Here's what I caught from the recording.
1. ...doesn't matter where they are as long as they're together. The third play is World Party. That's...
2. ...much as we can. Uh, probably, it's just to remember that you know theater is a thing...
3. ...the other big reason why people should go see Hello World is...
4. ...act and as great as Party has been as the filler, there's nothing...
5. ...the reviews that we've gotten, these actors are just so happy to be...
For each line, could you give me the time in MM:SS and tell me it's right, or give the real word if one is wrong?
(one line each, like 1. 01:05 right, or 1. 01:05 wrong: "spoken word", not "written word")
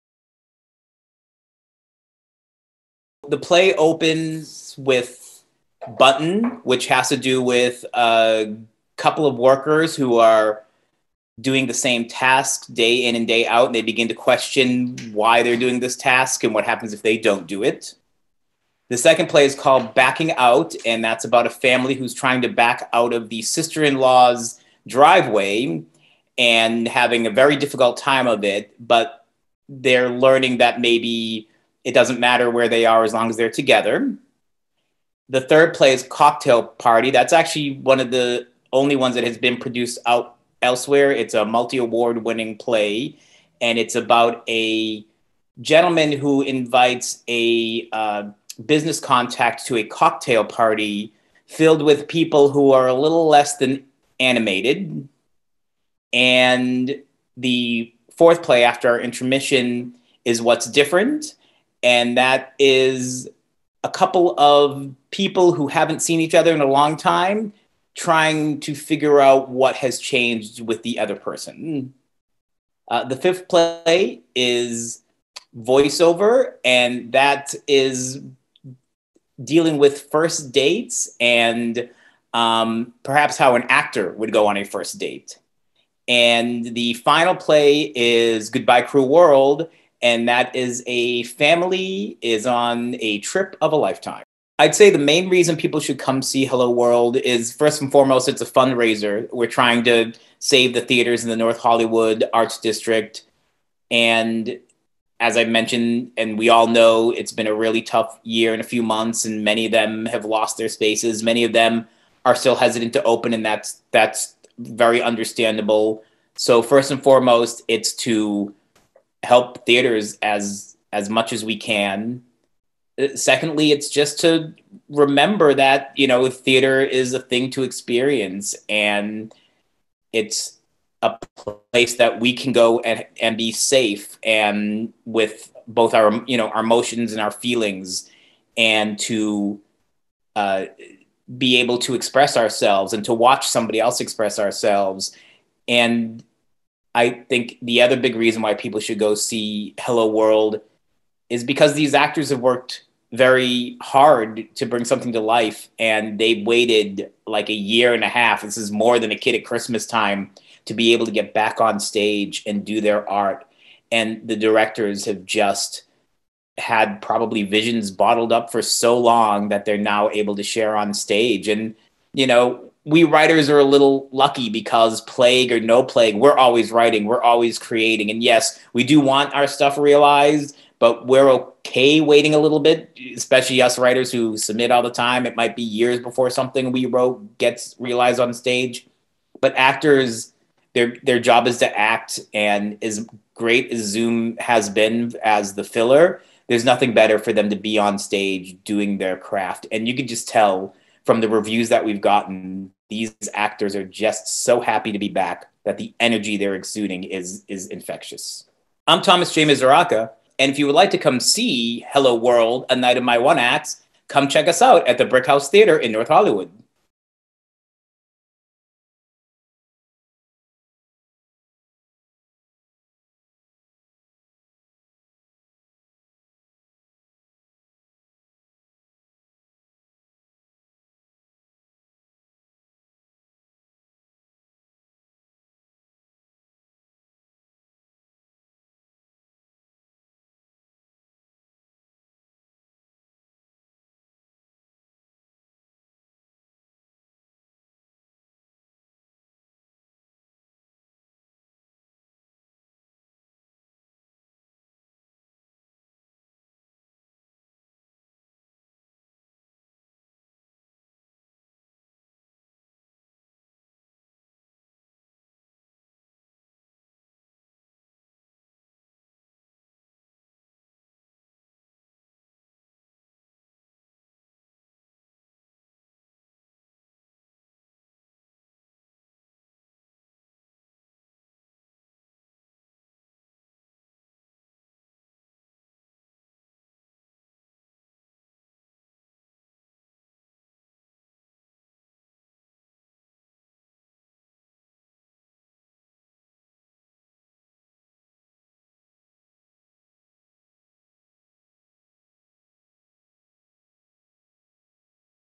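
1. 00:31 wrong: "Cocktail", not "World"
2. 02:01 wrong: "secondly", not "probably"
3. 02:27 right
4. 03:11 wrong: "Zoom", not "Party"
5. 03:21 right.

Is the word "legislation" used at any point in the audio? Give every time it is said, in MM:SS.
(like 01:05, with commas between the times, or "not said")
not said.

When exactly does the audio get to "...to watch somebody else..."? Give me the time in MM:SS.
02:23.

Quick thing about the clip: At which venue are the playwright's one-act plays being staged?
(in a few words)
Brick House Theater.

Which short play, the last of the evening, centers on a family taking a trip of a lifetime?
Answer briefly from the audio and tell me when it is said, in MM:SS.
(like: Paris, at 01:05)
Goodbye Cruel World, at 01:28.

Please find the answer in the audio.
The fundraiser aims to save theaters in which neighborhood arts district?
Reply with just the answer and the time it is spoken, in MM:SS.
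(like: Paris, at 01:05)
North Hollywood Arts District, at 01:41.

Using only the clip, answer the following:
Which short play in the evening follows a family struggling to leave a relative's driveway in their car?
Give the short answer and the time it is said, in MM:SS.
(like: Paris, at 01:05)
Backing Out, at 00:19.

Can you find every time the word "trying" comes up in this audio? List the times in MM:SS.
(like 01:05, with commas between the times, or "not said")
00:22, 01:07, 01:39.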